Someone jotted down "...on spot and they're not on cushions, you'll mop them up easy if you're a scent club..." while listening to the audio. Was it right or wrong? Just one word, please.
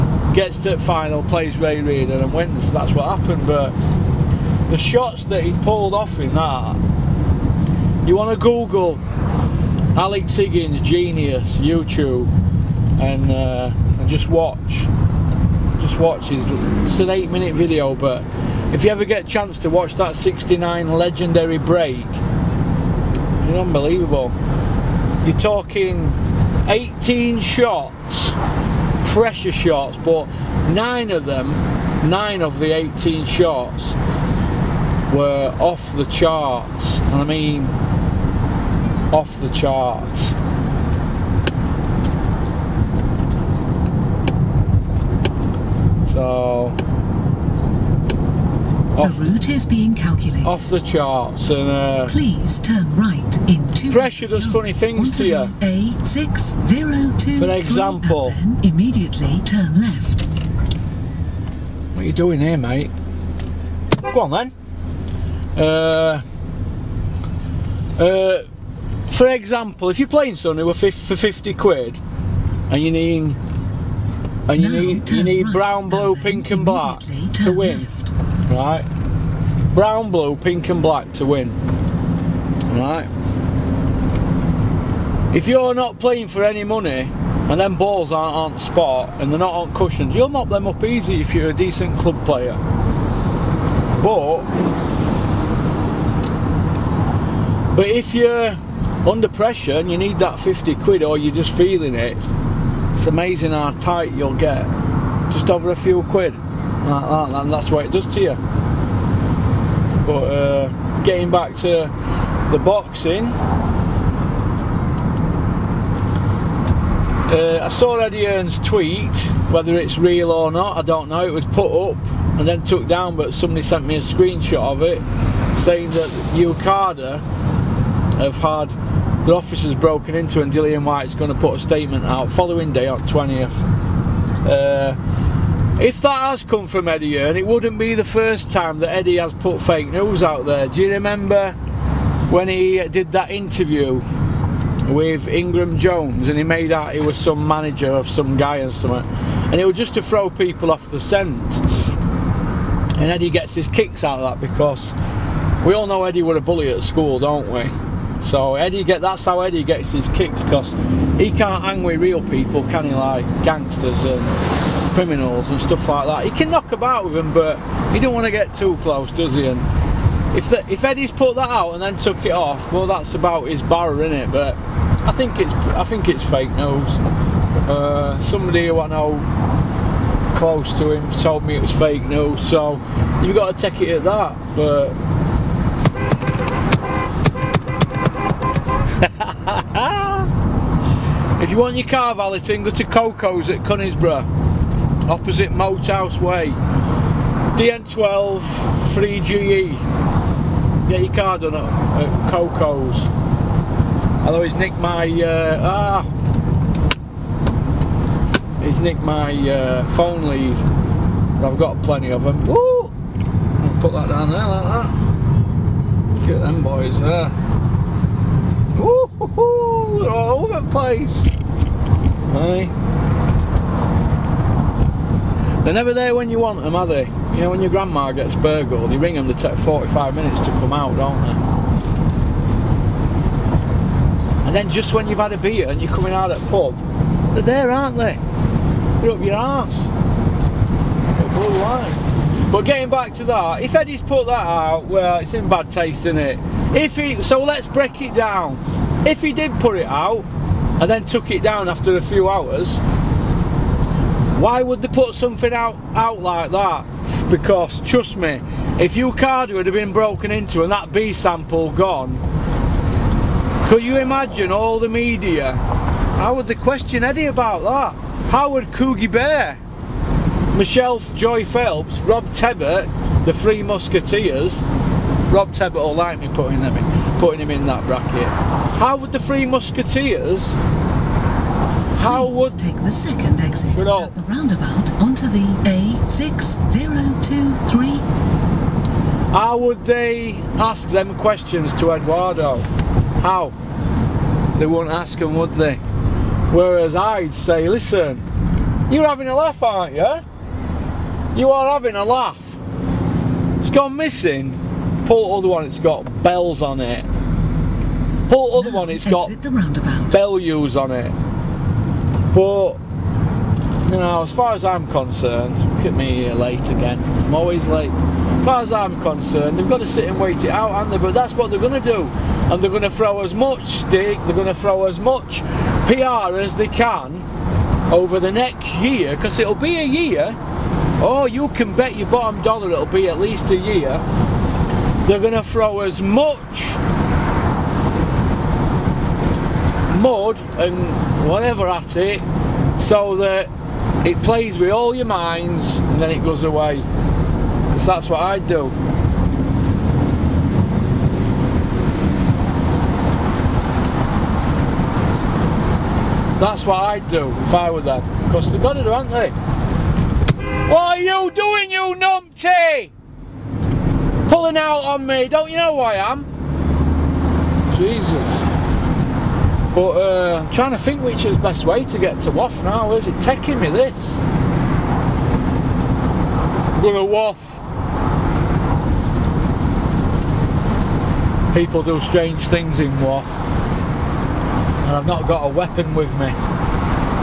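wrong.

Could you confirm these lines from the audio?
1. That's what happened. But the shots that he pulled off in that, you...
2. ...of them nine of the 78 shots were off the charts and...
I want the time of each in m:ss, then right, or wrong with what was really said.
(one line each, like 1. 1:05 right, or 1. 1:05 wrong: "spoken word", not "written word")
1. 0:02 right
2. 0:31 wrong: "18", not "78".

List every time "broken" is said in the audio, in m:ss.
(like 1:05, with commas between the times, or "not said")
2:09, 4:19.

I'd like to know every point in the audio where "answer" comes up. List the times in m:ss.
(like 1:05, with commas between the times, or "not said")
not said.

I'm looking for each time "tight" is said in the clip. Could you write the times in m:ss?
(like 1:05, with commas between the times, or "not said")
1:43.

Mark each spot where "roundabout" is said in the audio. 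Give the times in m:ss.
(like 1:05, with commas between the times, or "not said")
4:44, 5:09.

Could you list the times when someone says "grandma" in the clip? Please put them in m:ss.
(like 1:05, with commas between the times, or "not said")
3:47.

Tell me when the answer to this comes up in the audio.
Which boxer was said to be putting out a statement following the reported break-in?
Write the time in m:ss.
2:10.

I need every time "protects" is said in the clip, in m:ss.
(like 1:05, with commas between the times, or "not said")
not said.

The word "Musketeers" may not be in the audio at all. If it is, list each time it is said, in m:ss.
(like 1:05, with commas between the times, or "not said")
4:33, 4:39.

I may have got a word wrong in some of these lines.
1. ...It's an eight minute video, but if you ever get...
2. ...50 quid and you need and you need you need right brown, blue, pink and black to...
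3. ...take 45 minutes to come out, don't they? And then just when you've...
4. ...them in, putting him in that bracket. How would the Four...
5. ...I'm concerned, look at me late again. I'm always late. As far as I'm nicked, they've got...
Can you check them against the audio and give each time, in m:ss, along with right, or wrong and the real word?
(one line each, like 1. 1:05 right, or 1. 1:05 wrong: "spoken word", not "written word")
1. 0:16 right
2. 1:11 right
3. 3:49 right
4. 4:36 wrong: "Three", not "Four"
5. 5:14 wrong: "concerned", not "nicked".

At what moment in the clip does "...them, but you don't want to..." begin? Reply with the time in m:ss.
2:47.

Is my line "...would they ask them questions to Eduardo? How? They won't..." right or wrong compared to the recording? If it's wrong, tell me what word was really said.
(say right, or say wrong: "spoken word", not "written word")
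right.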